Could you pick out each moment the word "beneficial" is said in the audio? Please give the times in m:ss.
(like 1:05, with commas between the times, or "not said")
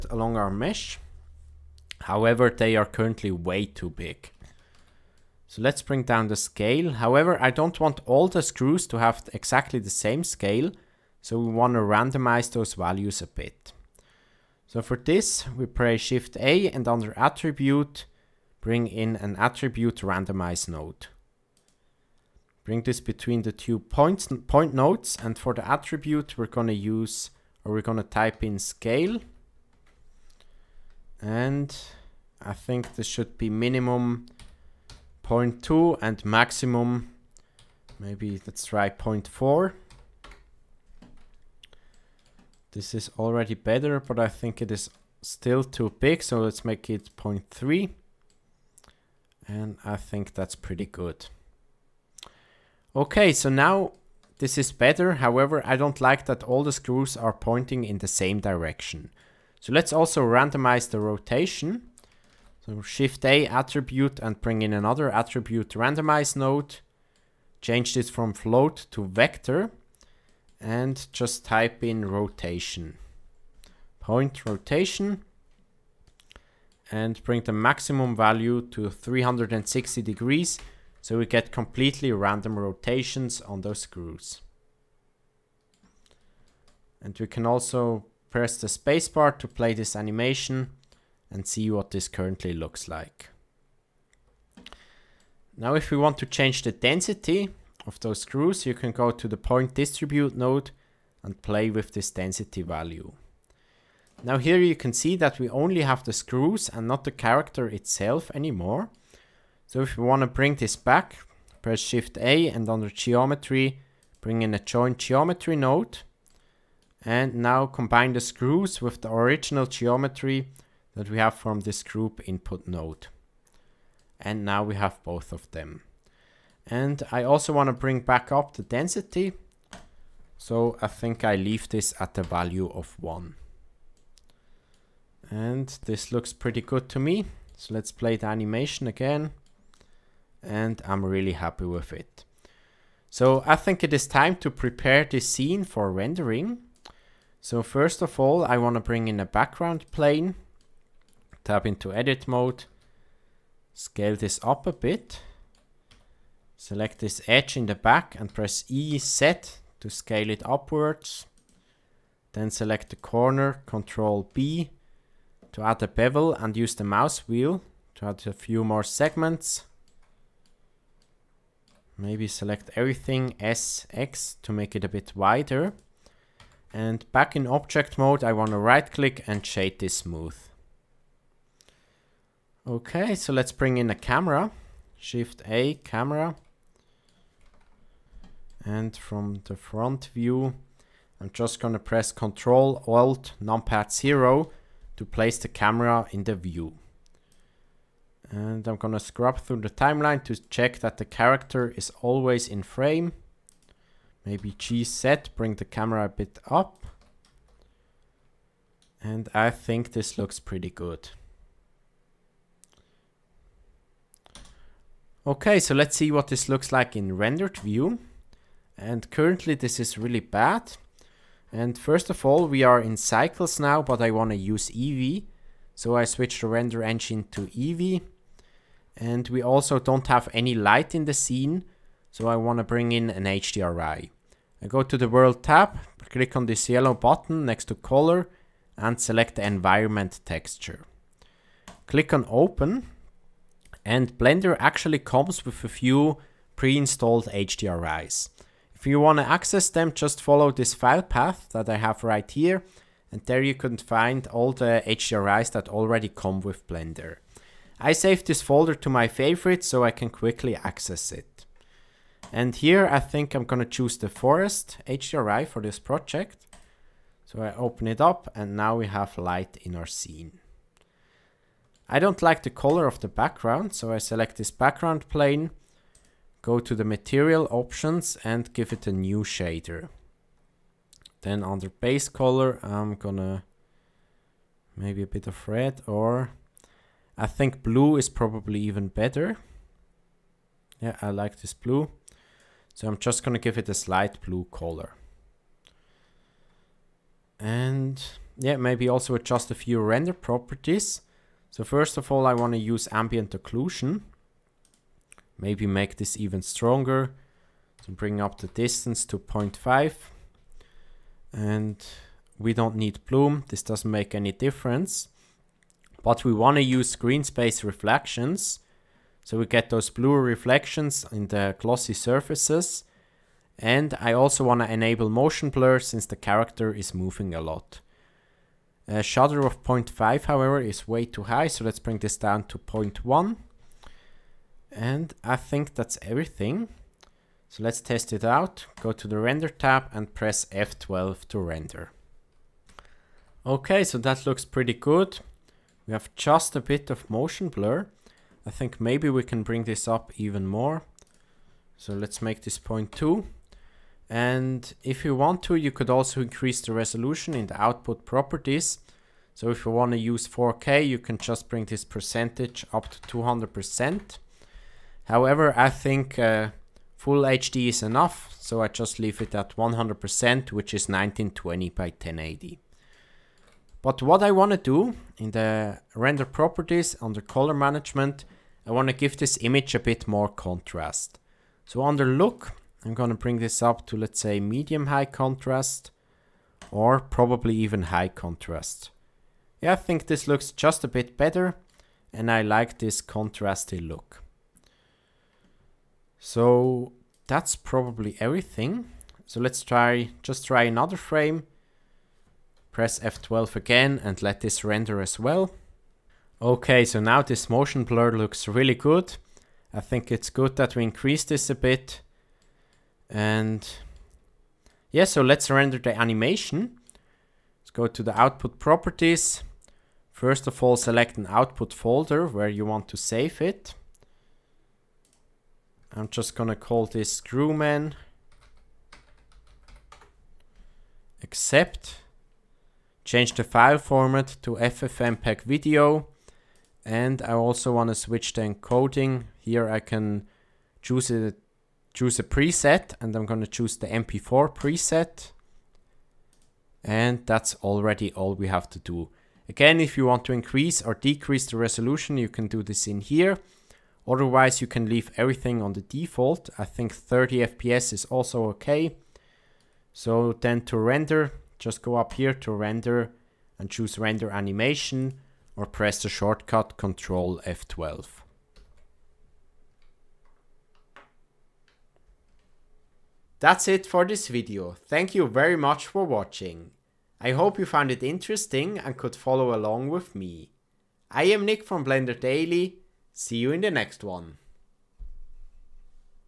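not said.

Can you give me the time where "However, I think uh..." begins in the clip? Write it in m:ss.
6:05.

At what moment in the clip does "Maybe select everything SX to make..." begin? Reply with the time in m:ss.
2:51.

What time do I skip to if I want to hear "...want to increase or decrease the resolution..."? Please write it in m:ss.
7:30.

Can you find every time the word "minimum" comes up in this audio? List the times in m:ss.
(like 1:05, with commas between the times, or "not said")
0:33.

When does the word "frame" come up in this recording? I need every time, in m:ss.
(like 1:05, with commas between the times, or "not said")
3:22, 6:40.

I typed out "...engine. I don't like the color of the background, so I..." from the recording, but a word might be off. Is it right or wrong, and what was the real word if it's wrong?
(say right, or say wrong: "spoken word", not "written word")
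wrong: "scene", not "engine".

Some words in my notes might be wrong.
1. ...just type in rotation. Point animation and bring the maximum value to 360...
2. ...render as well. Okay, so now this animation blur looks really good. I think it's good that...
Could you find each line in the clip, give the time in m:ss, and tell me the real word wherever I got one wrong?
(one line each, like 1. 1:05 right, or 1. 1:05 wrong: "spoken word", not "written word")
1. 1:11 wrong: "rotation", not "animation"
2. 6:44 wrong: "motion", not "animation".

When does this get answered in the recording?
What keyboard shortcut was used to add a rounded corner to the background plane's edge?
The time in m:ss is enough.
2:43.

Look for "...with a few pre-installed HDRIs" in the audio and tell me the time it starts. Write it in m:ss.
4:05.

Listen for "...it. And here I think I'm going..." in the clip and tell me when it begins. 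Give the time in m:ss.
4:21.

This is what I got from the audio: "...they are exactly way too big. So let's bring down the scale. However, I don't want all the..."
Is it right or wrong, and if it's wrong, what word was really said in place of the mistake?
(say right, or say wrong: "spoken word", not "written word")
wrong: "currently", not "exactly".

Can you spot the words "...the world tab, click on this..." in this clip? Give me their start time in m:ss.
3:54.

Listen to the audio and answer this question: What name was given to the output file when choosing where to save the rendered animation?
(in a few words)
Screwman.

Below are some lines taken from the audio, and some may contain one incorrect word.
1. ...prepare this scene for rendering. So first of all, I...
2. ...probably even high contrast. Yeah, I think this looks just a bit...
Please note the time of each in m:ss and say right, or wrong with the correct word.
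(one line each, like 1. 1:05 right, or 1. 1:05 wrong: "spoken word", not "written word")
1. 2:24 right
2. 6:26 right.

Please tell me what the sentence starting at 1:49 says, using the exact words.
So if we want to bring this back, press Shift A and under geometry, bring in a Join geometry node.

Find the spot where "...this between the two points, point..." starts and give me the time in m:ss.
0:22.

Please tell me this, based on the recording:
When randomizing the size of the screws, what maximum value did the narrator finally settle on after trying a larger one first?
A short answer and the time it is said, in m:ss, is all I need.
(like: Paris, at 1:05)
0.3, at 0:47.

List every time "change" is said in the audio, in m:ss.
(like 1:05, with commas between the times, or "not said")
1:07, 1:36, 7:13.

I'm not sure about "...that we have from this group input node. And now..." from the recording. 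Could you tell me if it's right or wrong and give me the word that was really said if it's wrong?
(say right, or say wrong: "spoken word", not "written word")
right.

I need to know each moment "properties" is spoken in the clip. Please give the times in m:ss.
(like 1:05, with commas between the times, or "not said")
5:00, 5:58, 6:16, 6:58.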